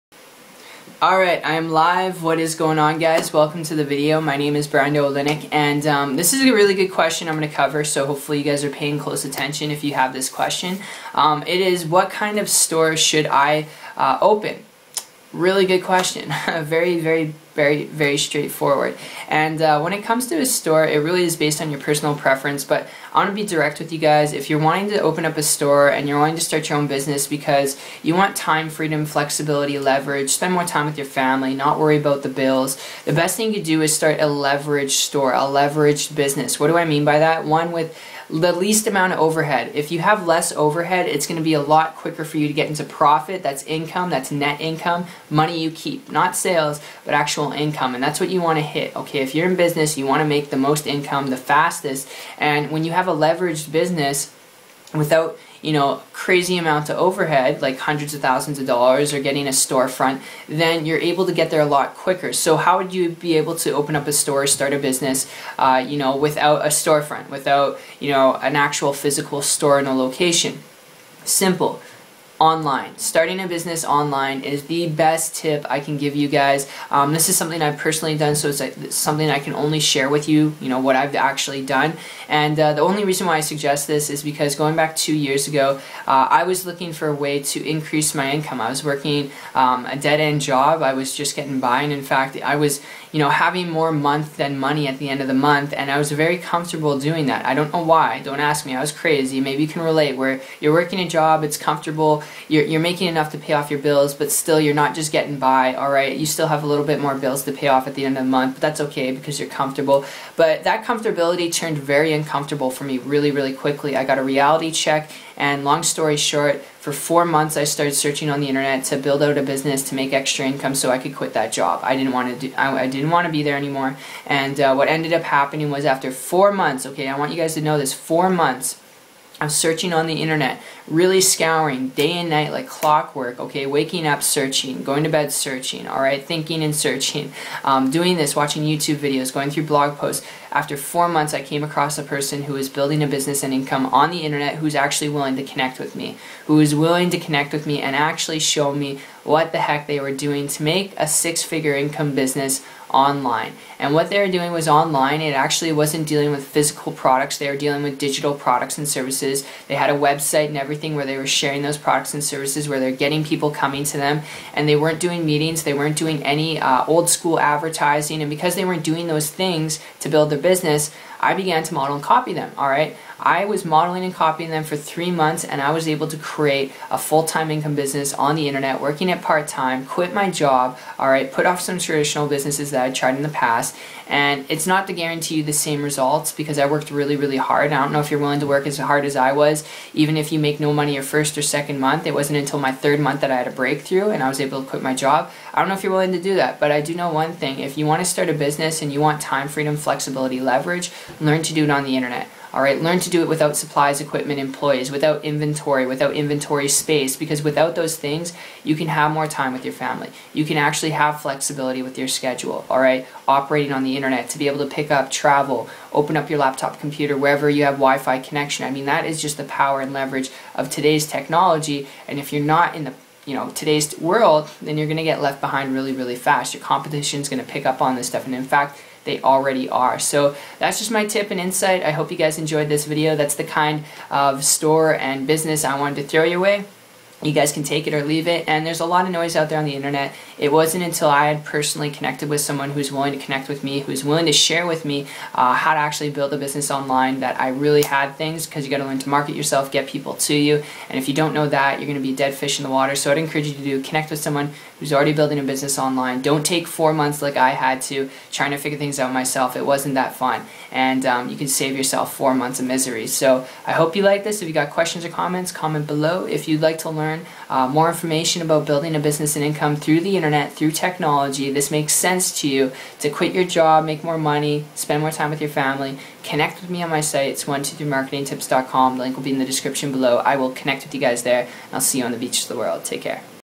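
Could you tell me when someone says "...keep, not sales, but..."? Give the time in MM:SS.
00:45.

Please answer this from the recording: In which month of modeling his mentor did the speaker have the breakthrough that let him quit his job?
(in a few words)
third month.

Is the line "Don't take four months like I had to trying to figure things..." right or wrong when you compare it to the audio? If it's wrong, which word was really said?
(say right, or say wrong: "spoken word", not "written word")
right.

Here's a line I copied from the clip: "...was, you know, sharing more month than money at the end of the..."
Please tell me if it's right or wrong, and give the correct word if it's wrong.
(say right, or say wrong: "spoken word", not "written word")
wrong: "having", not "sharing".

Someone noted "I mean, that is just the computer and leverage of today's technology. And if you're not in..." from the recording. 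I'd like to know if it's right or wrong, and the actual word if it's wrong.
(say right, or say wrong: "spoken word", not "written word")
wrong: "power", not "computer".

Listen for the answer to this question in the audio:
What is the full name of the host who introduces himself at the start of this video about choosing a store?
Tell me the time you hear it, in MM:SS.
00:04.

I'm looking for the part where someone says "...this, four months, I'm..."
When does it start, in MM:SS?
02:07.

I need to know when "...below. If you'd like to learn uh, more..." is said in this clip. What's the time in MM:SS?
04:25.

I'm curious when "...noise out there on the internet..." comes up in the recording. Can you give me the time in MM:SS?
03:59.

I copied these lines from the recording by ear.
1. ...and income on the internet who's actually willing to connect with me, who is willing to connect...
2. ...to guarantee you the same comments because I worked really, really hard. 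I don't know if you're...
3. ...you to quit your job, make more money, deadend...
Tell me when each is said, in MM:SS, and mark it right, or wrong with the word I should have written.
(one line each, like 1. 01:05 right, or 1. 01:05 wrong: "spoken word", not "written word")
1. 02:23 right
2. 03:04 wrong: "results", not "comments"
3. 04:32 wrong: "spend", not "deadend".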